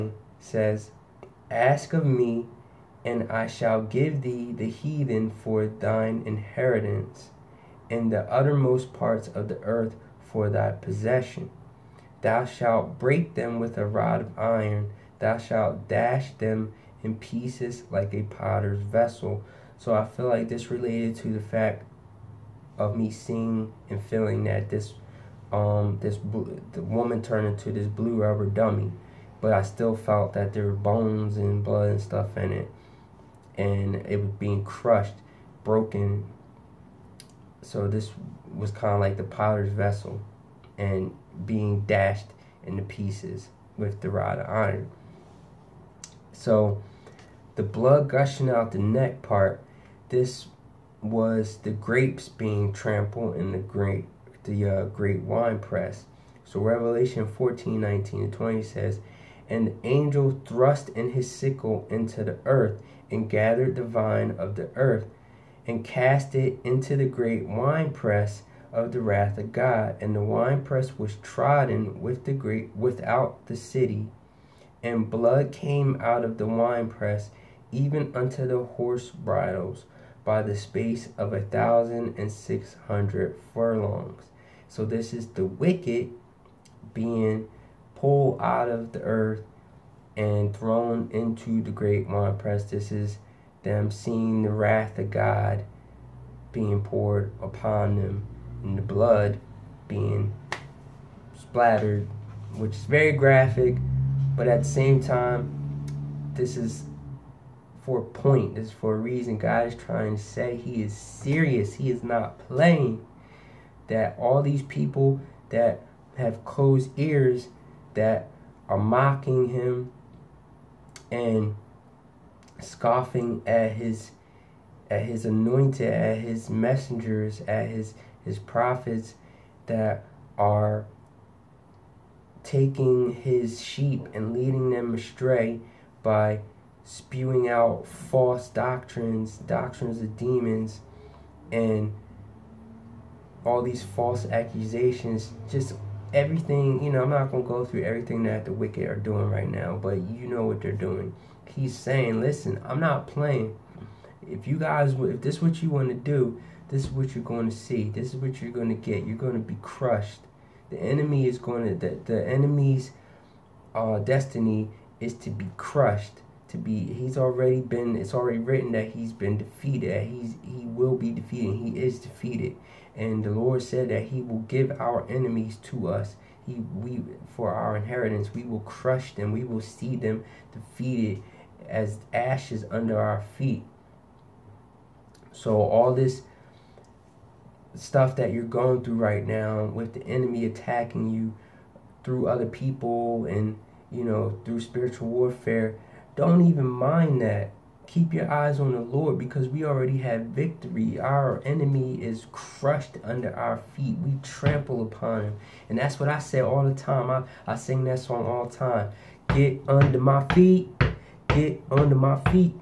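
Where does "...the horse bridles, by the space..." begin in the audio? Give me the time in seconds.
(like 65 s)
78 s.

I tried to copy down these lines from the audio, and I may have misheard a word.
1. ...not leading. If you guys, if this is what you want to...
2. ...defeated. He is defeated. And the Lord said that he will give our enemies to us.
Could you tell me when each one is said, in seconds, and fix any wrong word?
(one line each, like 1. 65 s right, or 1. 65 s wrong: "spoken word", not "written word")
1. 152 s wrong: "playing", not "leading"
2. 171 s right.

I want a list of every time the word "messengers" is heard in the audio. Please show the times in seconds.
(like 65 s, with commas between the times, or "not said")
126 s.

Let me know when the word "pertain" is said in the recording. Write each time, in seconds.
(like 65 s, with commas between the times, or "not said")
not said.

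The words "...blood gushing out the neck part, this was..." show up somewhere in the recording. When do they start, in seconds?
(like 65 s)
47 s.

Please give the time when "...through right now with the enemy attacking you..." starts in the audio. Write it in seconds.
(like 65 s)
188 s.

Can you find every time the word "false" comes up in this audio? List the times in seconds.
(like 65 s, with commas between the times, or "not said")
137 s, 143 s.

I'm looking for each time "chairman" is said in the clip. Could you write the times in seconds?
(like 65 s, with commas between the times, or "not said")
not said.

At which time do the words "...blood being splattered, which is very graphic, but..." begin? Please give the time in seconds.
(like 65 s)
98 s.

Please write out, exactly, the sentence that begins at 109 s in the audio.
God is trying to say He is serious, He is not playing.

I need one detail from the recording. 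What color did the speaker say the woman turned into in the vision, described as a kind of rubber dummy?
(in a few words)
Blue.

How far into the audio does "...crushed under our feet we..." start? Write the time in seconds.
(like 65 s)
202 s.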